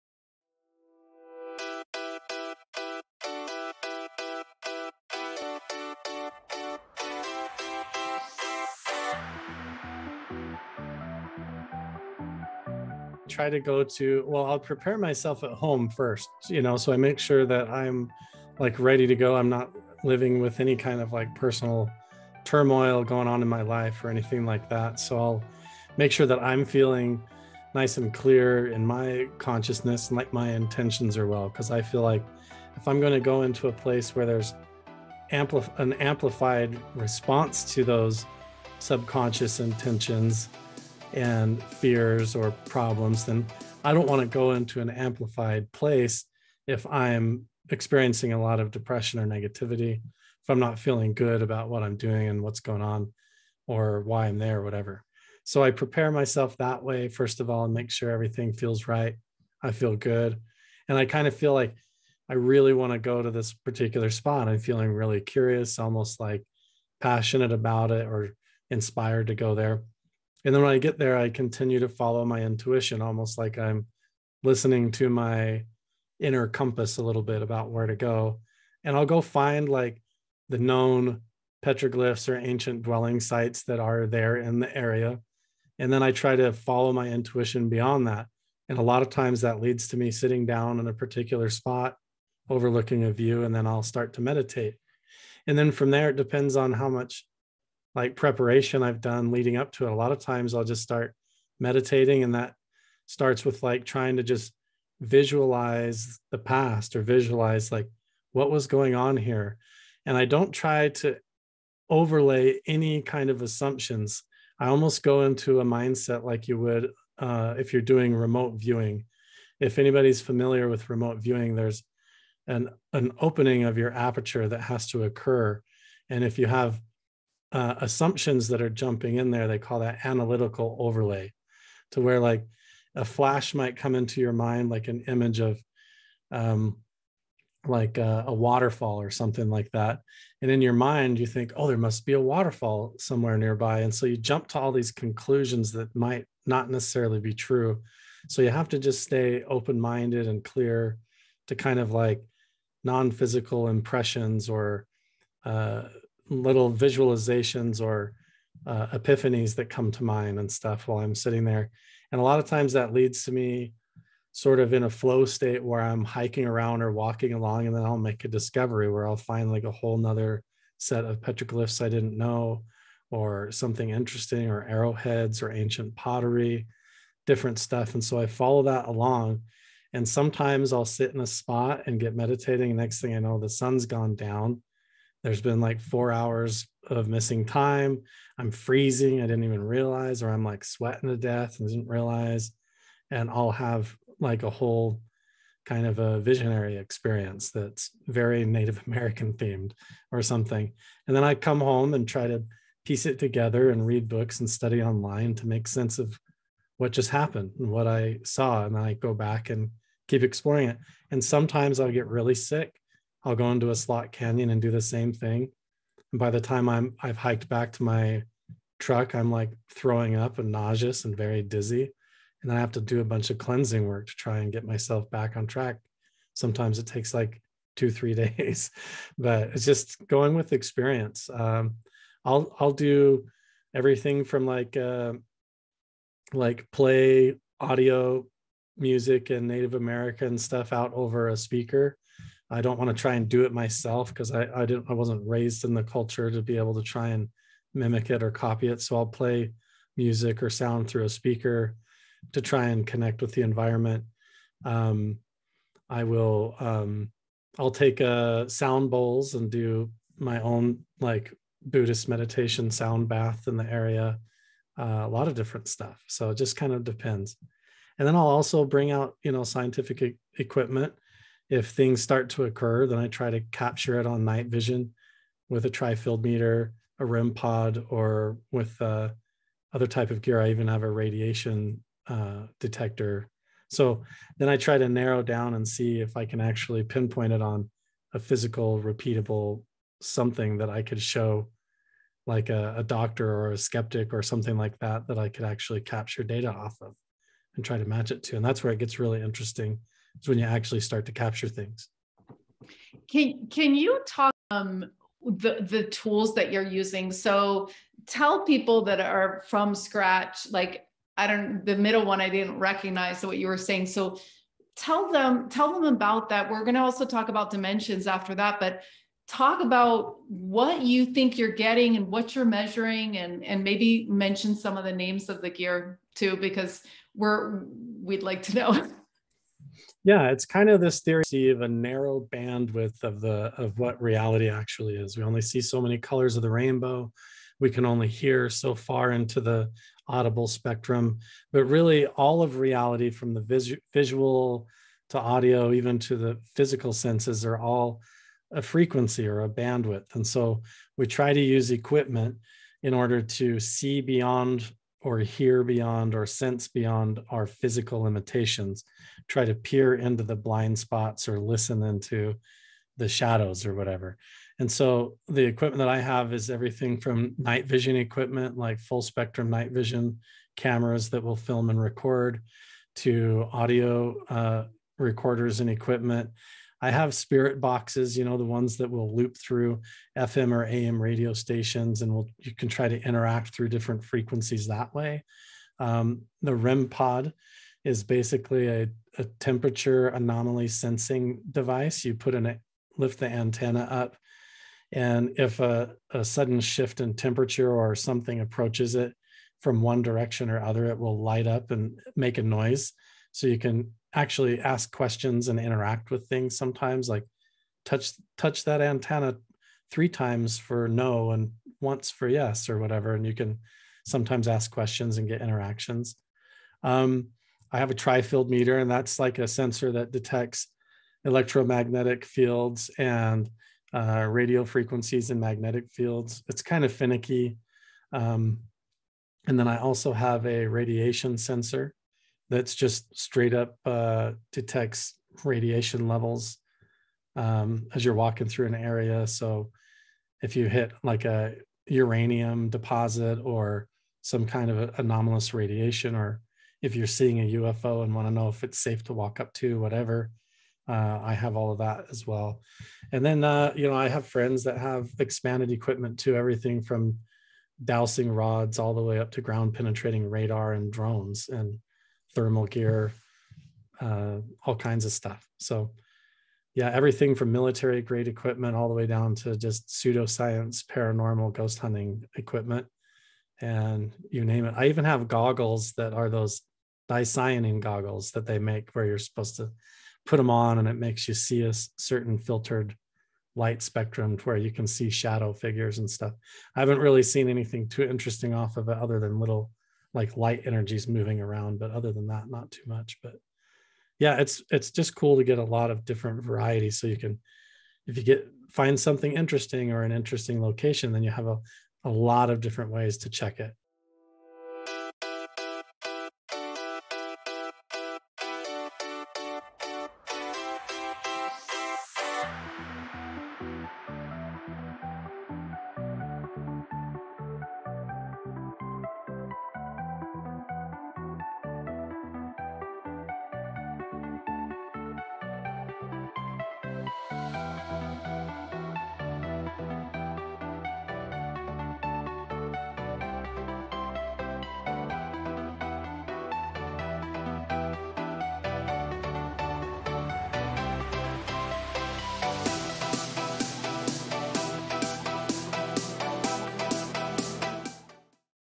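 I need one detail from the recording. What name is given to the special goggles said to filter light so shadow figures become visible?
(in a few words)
dicyanin goggles.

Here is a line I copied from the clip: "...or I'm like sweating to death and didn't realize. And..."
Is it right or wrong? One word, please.
right.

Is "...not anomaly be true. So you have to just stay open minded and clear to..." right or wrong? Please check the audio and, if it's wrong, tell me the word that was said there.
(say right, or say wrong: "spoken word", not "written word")
wrong: "necessarily", not "anomaly".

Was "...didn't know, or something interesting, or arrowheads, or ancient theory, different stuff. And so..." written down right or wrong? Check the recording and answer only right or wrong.
wrong.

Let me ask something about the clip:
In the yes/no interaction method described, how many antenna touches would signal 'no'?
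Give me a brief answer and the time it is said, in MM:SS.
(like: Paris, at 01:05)
3, at 06:49.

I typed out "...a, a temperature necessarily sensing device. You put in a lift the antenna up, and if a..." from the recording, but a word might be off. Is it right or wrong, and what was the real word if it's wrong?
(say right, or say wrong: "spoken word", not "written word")
wrong: "anomaly", not "necessarily".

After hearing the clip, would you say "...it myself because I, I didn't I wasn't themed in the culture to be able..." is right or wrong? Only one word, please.
wrong.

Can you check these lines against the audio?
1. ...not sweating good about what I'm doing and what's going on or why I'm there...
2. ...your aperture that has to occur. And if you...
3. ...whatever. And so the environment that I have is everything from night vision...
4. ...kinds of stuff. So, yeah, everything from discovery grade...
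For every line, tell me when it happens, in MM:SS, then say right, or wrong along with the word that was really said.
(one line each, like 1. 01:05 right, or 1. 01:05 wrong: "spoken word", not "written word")
1. 00:50 wrong: "feeling", not "sweating"
2. 02:03 right
3. 06:03 wrong: "equipment", not "environment"
4. 07:44 wrong: "military", not "discovery".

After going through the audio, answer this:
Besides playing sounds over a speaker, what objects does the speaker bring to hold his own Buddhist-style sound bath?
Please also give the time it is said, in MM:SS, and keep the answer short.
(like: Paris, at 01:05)
sound bowls, at 04:18.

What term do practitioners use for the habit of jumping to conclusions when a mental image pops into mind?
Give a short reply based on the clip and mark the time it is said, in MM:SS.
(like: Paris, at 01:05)
analytical overlay, at 02:10.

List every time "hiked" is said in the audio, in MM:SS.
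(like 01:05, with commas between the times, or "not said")
03:37.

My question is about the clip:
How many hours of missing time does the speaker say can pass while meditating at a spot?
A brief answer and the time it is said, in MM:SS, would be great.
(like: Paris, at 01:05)
4, at 03:05.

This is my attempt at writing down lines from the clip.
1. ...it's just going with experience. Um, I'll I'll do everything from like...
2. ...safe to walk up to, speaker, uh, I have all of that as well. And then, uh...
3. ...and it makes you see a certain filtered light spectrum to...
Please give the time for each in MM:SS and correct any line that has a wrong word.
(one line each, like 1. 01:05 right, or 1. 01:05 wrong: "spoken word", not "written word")
1. 03:49 right
2. 07:28 wrong: "whatever", not "speaker"
3. 08:00 right.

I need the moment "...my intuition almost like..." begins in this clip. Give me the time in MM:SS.
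01:12.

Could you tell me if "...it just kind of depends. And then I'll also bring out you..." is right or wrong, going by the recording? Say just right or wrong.
right.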